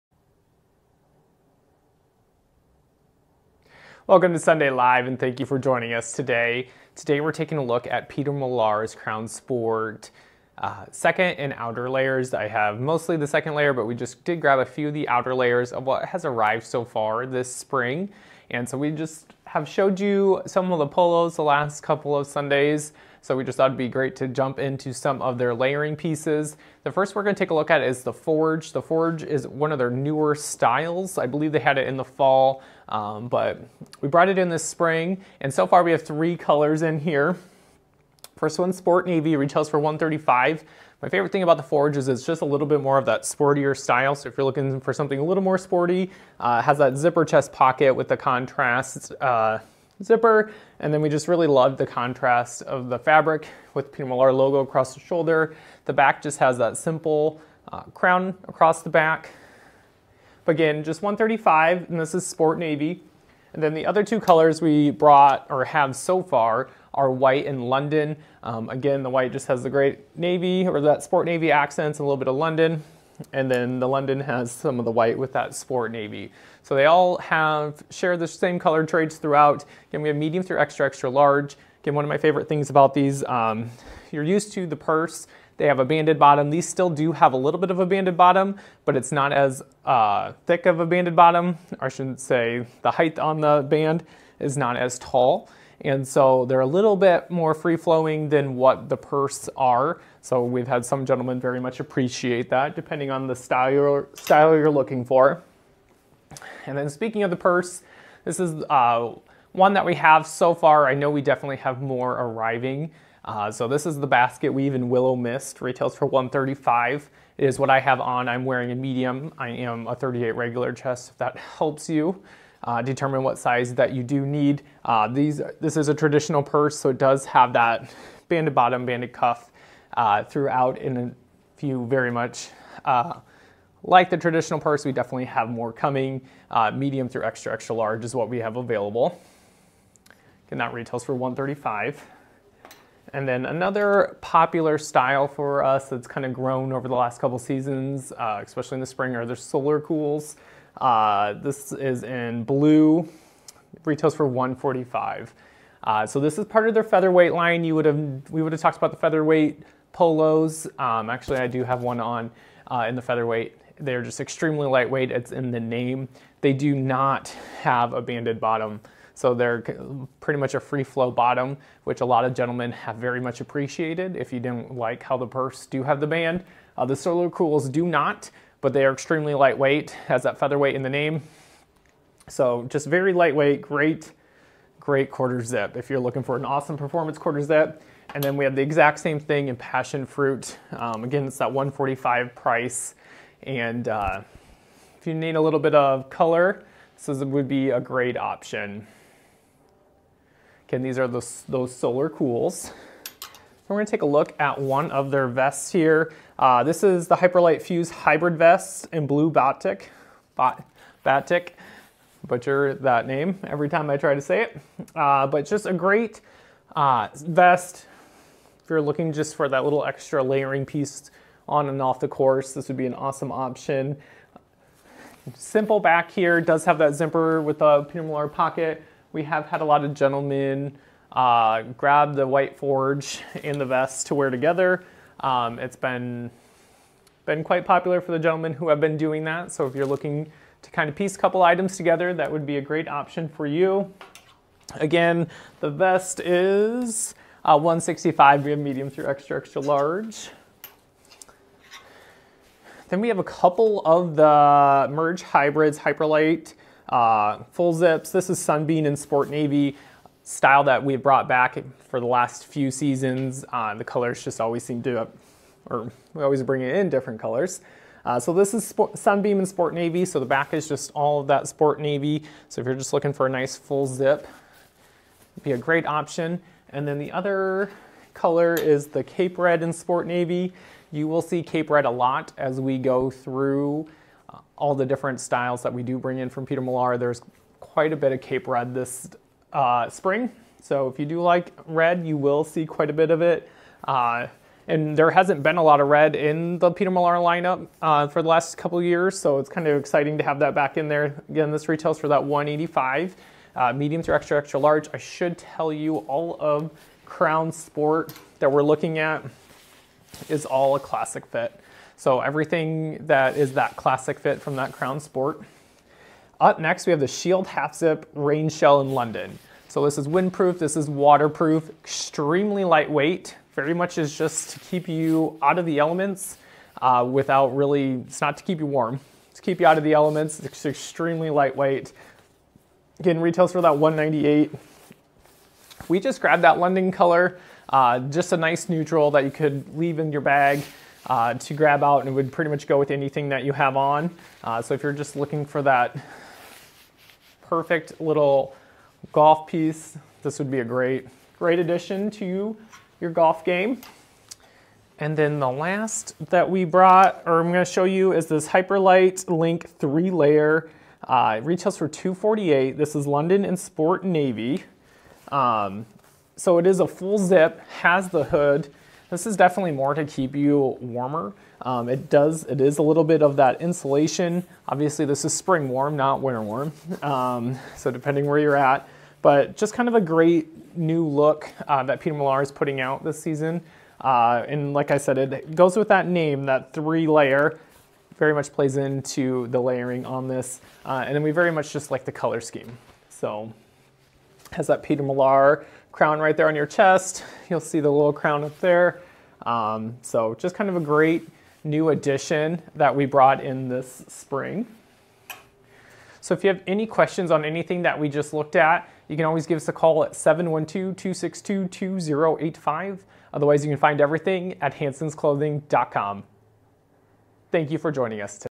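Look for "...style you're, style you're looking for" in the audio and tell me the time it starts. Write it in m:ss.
1:43.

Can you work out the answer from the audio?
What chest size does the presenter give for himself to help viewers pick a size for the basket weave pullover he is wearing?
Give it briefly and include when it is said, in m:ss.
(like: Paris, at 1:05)
38 regular, at 1:59.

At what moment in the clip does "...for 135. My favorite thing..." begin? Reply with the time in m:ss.
0:39.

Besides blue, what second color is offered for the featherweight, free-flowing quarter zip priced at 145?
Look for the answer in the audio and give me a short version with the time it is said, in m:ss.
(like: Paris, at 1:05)
Passion fruit, at 3:09.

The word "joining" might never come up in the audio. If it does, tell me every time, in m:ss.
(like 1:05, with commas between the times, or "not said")
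0:05, 6:57.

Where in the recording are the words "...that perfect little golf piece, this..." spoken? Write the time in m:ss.
5:45.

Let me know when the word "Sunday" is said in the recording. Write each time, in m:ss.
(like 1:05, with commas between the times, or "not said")
0:04, 0:22.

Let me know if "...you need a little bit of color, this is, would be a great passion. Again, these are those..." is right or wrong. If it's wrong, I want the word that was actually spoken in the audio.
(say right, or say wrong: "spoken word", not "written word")
wrong: "option", not "passion".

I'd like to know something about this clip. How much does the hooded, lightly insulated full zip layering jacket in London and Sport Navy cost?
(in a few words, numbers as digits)
$248.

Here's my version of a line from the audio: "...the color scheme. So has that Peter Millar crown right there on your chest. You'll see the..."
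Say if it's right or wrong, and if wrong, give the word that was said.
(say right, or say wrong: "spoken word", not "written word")
right.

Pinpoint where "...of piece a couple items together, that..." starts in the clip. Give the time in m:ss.
4:00.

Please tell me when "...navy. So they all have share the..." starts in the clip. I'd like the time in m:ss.
1:15.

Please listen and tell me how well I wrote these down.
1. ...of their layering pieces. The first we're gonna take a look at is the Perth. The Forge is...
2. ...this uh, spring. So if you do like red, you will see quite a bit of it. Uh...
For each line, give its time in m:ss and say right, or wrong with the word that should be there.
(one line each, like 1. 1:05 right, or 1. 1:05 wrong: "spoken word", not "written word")
1. 0:25 wrong: "Forge", not "Perth"
2. 4:48 right.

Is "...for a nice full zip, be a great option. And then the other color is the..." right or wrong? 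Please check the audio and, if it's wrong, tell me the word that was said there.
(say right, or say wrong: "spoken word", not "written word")
right.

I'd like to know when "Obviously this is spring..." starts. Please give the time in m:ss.
6:14.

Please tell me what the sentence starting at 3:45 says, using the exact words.
Simple back here, does have that zipper with a Pinot Noir pocket.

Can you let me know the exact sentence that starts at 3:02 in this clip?
So just very lightweight, great, great quarter zip.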